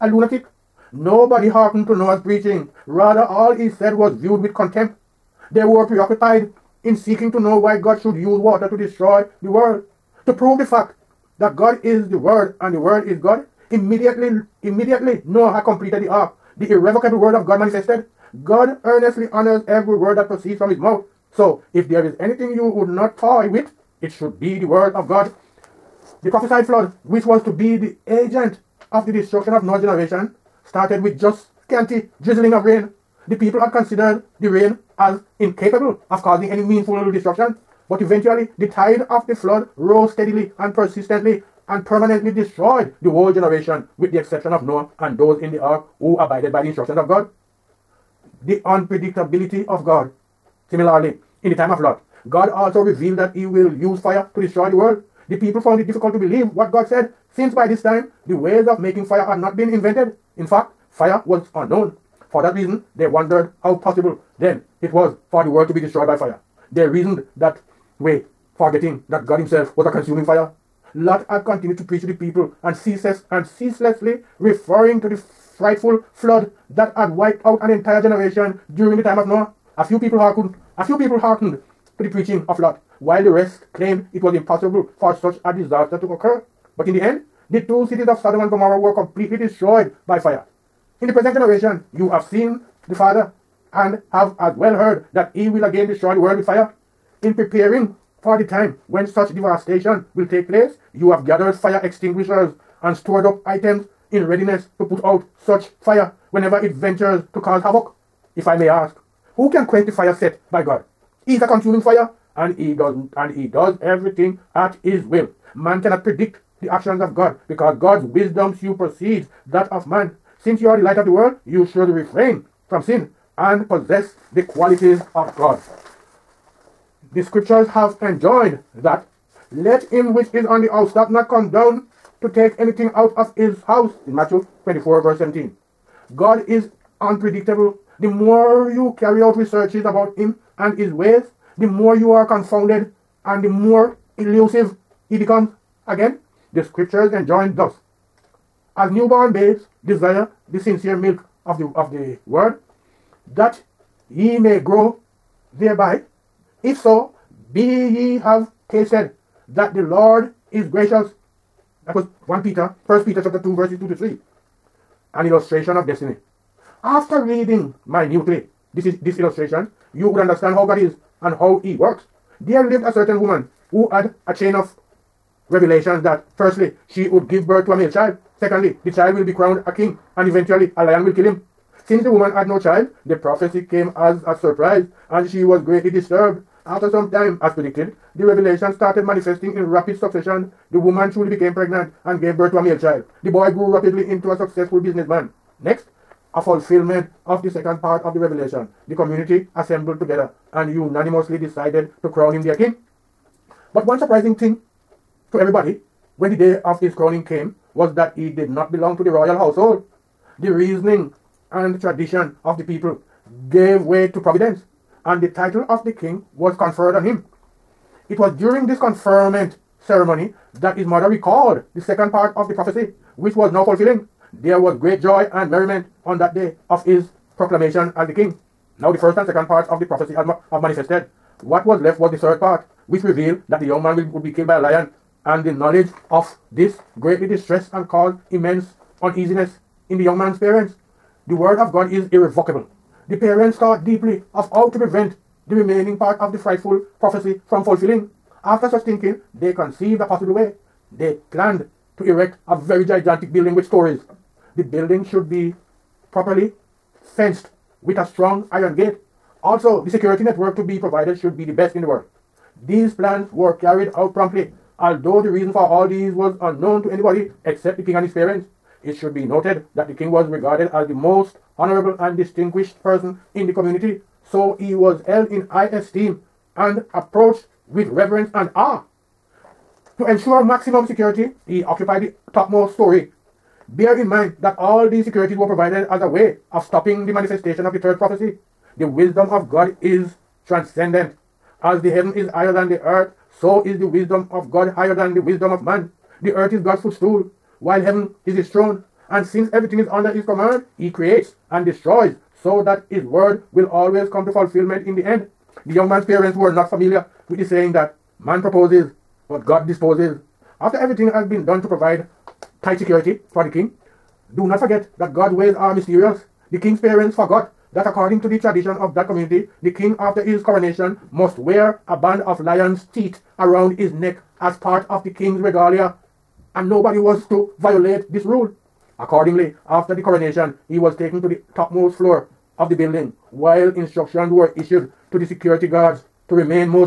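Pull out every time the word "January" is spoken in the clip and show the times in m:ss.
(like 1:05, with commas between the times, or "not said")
not said.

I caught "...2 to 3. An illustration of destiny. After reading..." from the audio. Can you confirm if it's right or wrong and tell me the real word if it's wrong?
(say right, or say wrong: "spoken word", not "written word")
right.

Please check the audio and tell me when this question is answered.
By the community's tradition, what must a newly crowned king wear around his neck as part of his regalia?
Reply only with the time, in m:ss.
5:21.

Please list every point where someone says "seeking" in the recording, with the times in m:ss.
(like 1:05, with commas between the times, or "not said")
0:06.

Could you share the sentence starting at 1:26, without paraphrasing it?
But in the end, the two cities of Sodom and Gomorrah were completely destroyed by fire.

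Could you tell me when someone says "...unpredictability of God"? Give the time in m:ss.
0:48.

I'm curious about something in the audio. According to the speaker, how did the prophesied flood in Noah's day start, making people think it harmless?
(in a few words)
Scanty drizzling of rain.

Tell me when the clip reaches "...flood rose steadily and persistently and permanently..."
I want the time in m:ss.
0:39.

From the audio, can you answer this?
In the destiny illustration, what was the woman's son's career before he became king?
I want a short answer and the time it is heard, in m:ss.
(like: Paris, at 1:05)
Businessman, at 3:14.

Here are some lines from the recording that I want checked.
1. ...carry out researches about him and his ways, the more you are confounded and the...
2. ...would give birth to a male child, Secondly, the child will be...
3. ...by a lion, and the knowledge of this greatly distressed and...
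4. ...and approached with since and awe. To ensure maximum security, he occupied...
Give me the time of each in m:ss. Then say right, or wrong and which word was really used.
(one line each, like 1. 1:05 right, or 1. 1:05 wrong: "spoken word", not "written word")
1. 2:18 right
2. 2:57 right
3. 3:54 right
4. 4:36 wrong: "reverence", not "since".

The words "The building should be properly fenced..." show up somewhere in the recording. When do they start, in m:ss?
4:14.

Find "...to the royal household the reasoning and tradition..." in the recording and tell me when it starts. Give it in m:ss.
3:28.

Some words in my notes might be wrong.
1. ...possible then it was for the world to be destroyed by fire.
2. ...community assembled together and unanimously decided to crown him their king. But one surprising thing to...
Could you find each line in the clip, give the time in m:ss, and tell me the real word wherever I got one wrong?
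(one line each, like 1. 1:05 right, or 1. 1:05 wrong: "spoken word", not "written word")
1. 1:03 right
2. 3:18 right.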